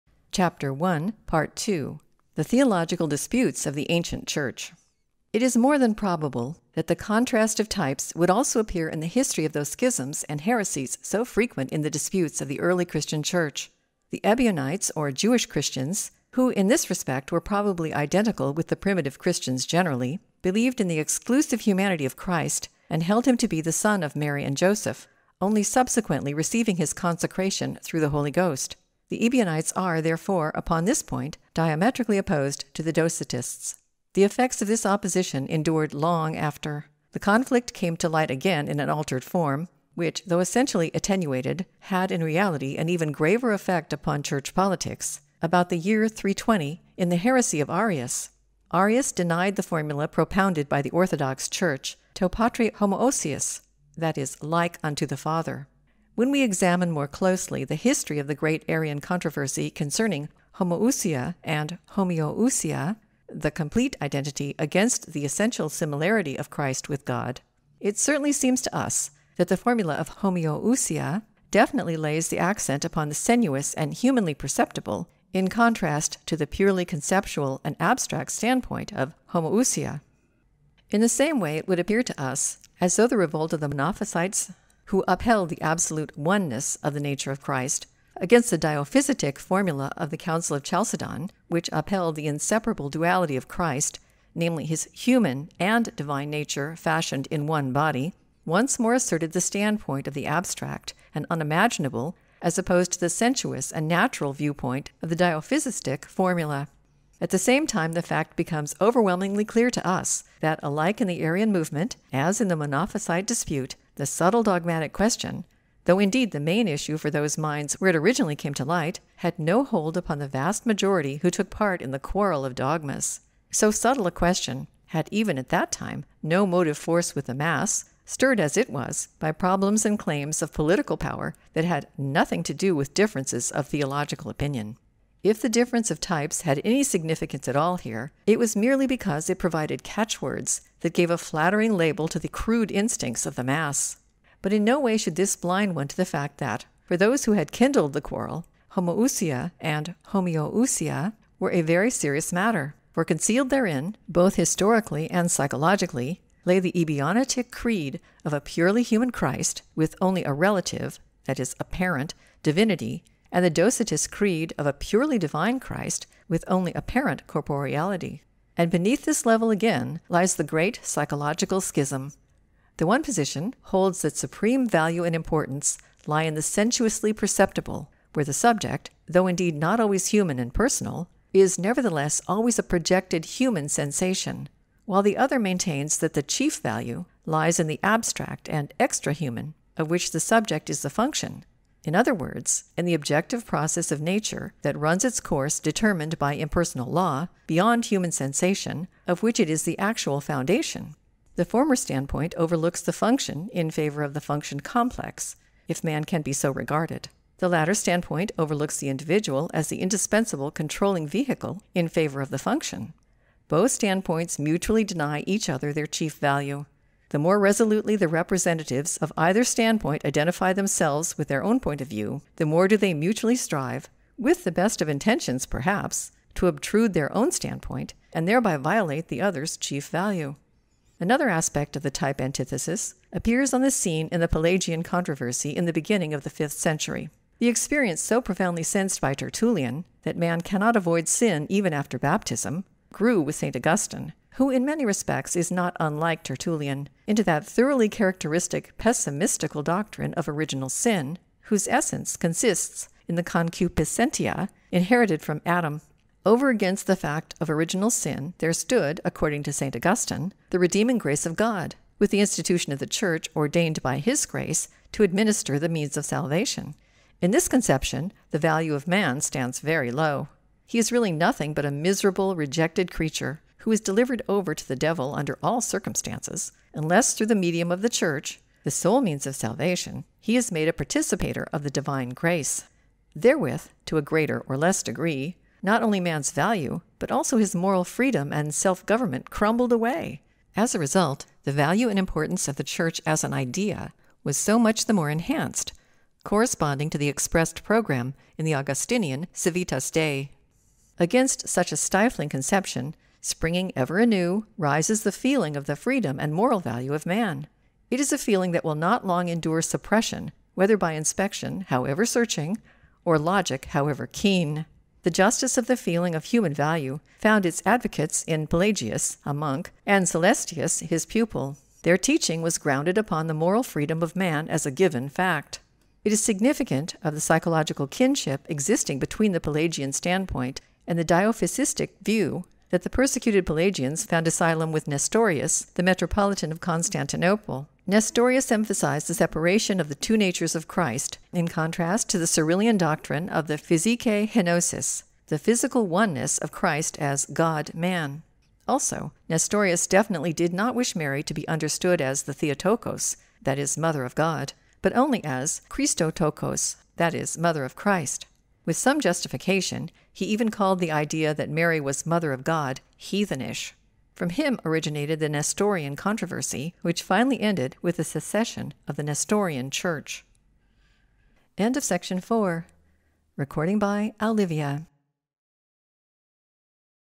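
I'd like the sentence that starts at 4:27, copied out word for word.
In this conception, the value of man stands very low.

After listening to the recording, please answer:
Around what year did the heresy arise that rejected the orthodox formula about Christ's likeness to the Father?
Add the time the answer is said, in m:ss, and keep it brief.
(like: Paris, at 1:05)
320, at 0:46.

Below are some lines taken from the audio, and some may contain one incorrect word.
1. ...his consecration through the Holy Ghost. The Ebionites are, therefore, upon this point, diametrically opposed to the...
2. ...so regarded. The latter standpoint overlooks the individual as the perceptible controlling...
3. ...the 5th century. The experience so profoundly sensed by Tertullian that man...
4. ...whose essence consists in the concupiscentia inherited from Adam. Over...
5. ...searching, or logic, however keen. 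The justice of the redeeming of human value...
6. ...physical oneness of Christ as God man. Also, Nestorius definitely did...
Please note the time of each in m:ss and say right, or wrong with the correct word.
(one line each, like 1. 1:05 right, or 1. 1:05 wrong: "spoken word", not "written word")
1. 0:26 right
2. 3:26 wrong: "indispensable", not "perceptible"
3. 3:56 right
4. 4:11 right
5. 5:12 wrong: "feeling", not "redeeming"
6. 5:45 right.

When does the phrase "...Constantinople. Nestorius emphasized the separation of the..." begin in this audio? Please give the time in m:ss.
5:36.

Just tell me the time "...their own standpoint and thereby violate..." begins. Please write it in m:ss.
3:46.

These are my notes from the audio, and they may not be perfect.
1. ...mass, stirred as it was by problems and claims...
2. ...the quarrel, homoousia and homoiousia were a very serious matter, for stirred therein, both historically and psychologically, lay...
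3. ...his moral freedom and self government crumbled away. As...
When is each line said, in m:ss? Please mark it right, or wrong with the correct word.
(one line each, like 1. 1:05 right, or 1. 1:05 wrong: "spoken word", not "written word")
1. 2:07 right
2. 2:27 wrong: "concealed", not "stirred"
3. 4:47 right.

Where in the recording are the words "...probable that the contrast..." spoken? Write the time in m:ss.
0:05.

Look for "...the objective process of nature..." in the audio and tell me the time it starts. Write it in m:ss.
3:12.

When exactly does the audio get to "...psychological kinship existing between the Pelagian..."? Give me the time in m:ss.
5:27.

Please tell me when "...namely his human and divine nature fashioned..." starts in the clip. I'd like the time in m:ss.
1:34.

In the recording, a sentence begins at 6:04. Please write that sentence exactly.
From him originated the Nestorian controversy, which finally ended with the secession of the Nestorian Church.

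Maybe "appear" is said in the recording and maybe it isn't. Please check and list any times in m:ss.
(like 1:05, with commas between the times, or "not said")
0:08, 1:21, 3:53.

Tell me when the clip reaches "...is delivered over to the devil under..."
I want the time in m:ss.
4:33.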